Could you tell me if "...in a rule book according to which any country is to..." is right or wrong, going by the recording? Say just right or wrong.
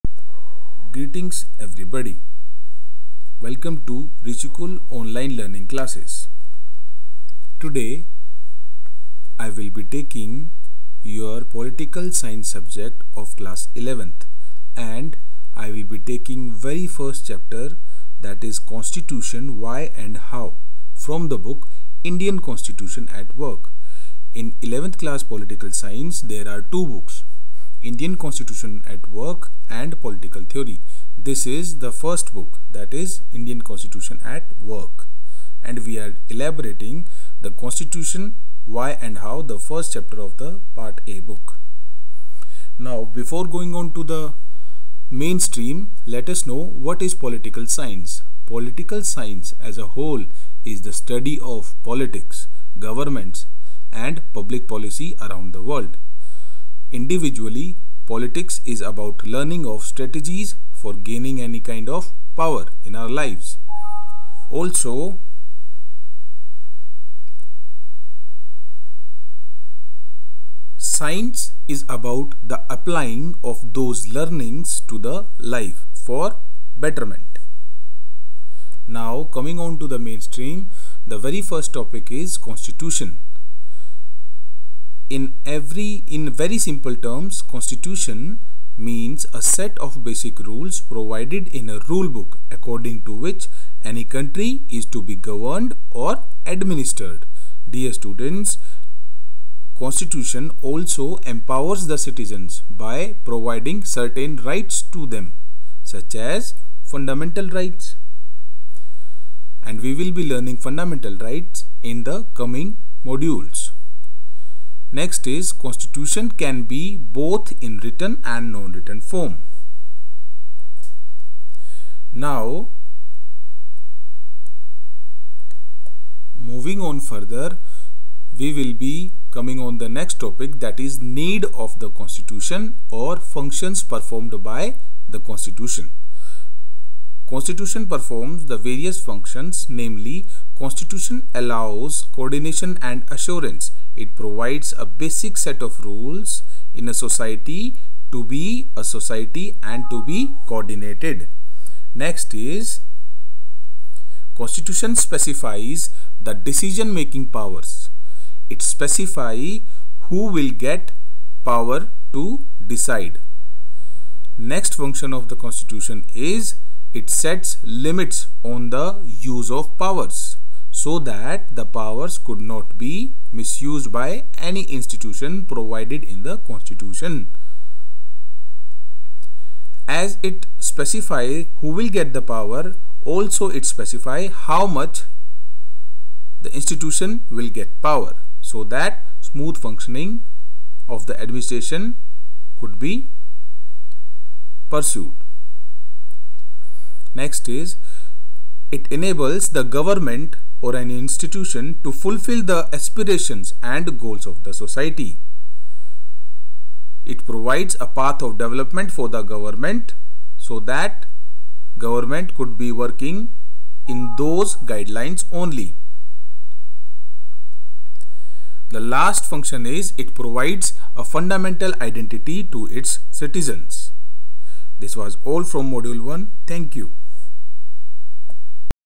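right.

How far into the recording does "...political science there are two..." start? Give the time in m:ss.
0:25.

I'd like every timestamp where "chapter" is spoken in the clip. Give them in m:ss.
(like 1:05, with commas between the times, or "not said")
0:17, 0:39.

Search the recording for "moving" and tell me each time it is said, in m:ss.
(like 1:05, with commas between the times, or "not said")
2:06.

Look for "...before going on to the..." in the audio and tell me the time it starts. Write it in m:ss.
0:43.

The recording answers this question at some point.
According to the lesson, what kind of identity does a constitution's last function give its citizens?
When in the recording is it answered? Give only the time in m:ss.
3:41.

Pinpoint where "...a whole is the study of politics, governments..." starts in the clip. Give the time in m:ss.
0:49.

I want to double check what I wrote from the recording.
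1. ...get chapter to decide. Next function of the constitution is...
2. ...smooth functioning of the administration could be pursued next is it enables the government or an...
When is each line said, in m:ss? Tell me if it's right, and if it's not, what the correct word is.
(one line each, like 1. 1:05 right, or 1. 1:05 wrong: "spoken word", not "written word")
1. 2:40 wrong: "power", not "chapter"
2. 3:09 right.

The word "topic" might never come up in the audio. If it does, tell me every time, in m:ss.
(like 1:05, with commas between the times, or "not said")
1:21, 2:10.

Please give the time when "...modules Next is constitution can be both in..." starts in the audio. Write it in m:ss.
1:53.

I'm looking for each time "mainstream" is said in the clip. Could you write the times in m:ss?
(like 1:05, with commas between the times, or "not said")
0:45, 1:19.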